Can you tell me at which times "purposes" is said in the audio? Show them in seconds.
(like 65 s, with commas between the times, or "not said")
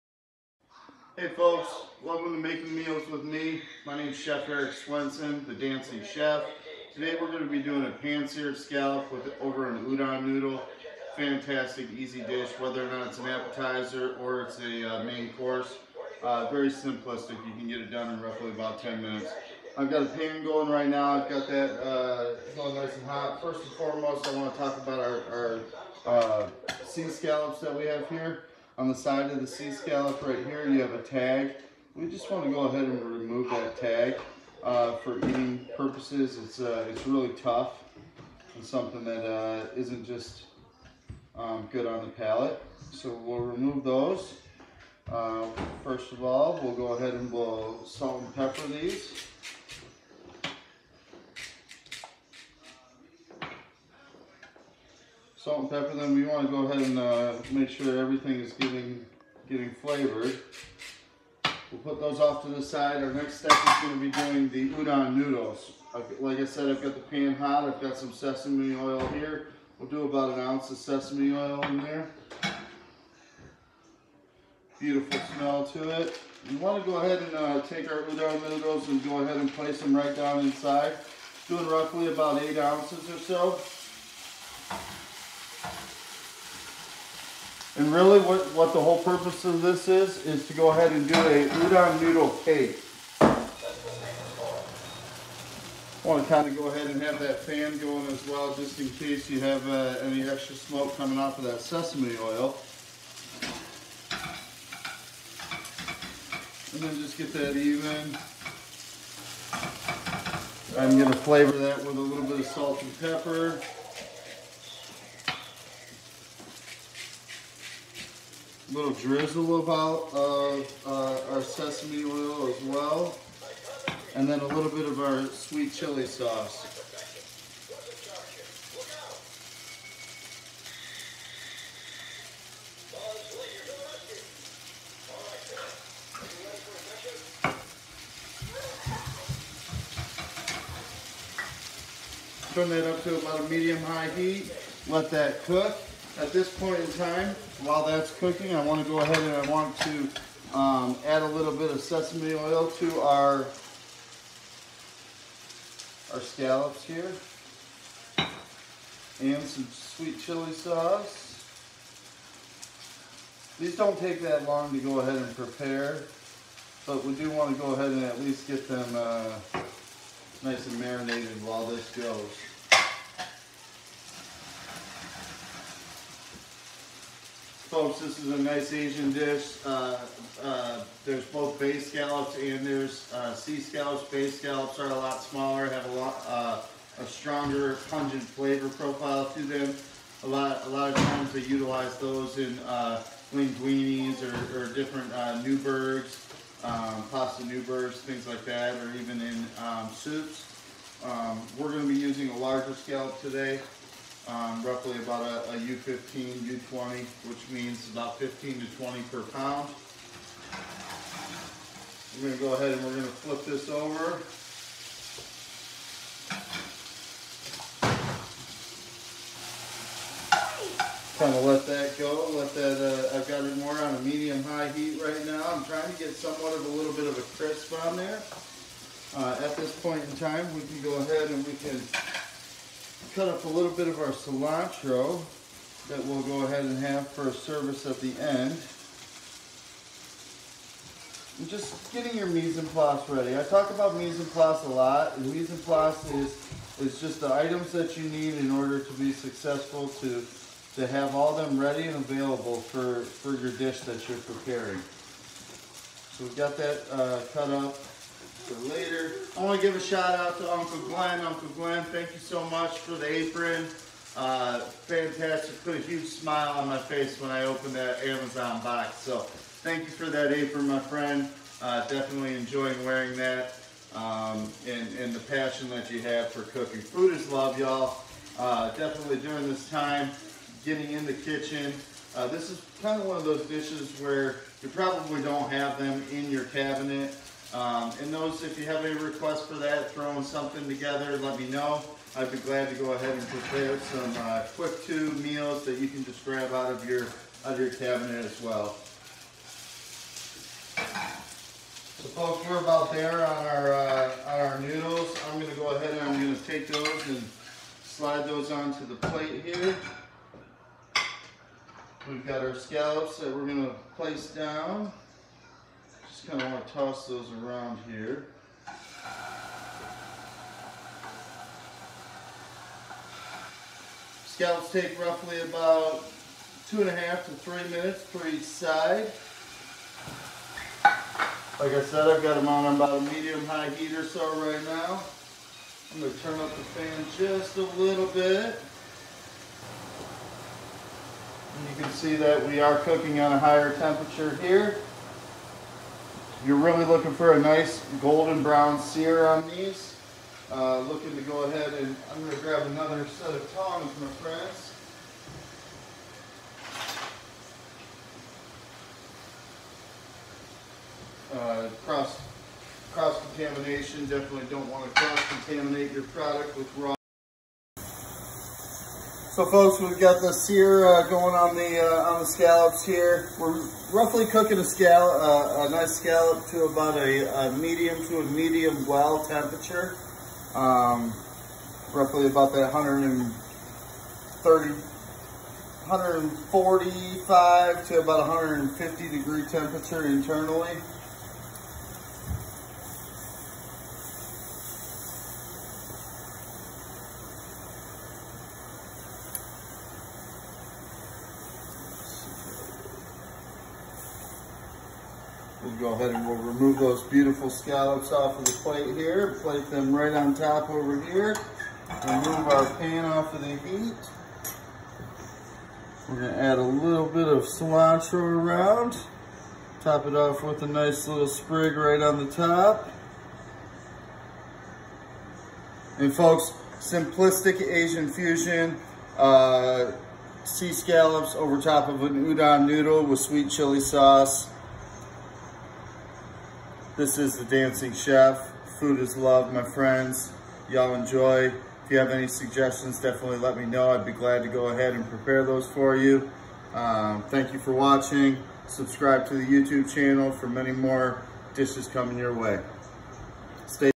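35 s, 89 s.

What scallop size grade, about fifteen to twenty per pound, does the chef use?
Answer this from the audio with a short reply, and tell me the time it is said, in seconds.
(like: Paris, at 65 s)
U15, U20, at 205 s.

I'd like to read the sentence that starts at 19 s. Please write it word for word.
I've got a pan going right now.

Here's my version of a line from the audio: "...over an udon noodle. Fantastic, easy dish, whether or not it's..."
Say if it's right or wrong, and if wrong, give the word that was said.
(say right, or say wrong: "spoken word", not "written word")
right.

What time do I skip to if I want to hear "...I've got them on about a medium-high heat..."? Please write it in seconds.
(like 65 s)
332 s.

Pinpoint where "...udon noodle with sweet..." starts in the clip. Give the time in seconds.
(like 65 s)
432 s.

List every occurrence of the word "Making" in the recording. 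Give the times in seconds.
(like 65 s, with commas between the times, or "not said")
2 s.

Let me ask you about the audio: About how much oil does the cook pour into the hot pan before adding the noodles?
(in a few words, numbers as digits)
1 ounce.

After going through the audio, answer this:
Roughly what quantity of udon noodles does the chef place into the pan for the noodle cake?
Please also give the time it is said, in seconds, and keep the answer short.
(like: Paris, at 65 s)
8 ounces, at 82 s.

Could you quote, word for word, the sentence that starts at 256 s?
So we've got that uh, cut up for later.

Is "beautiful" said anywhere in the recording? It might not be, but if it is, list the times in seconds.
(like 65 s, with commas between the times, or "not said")
74 s, 407 s.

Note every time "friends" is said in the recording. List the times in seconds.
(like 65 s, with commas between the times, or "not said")
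270 s, 354 s, 439 s.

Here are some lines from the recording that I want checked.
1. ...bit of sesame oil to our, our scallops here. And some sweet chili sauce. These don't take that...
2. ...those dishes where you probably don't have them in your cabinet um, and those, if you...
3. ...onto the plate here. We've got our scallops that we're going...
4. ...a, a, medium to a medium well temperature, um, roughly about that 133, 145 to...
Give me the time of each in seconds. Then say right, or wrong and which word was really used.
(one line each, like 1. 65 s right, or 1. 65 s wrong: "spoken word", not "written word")
1. 151 s right
2. 283 s right
3. 308 s right
4. 376 s wrong: "130", not "133".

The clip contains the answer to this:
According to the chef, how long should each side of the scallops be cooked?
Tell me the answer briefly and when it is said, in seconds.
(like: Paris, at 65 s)
2.5 to 3 minutes, at 326 s.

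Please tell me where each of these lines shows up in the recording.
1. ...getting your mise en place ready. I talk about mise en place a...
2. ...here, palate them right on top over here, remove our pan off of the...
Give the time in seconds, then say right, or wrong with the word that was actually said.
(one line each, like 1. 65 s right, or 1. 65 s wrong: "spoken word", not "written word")
1. 241 s right
2. 408 s wrong: "plate", not "palate".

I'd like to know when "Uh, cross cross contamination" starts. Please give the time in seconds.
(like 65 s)
361 s.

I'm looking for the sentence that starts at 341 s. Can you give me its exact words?
And you can see that we are cooking on a higher temperature here.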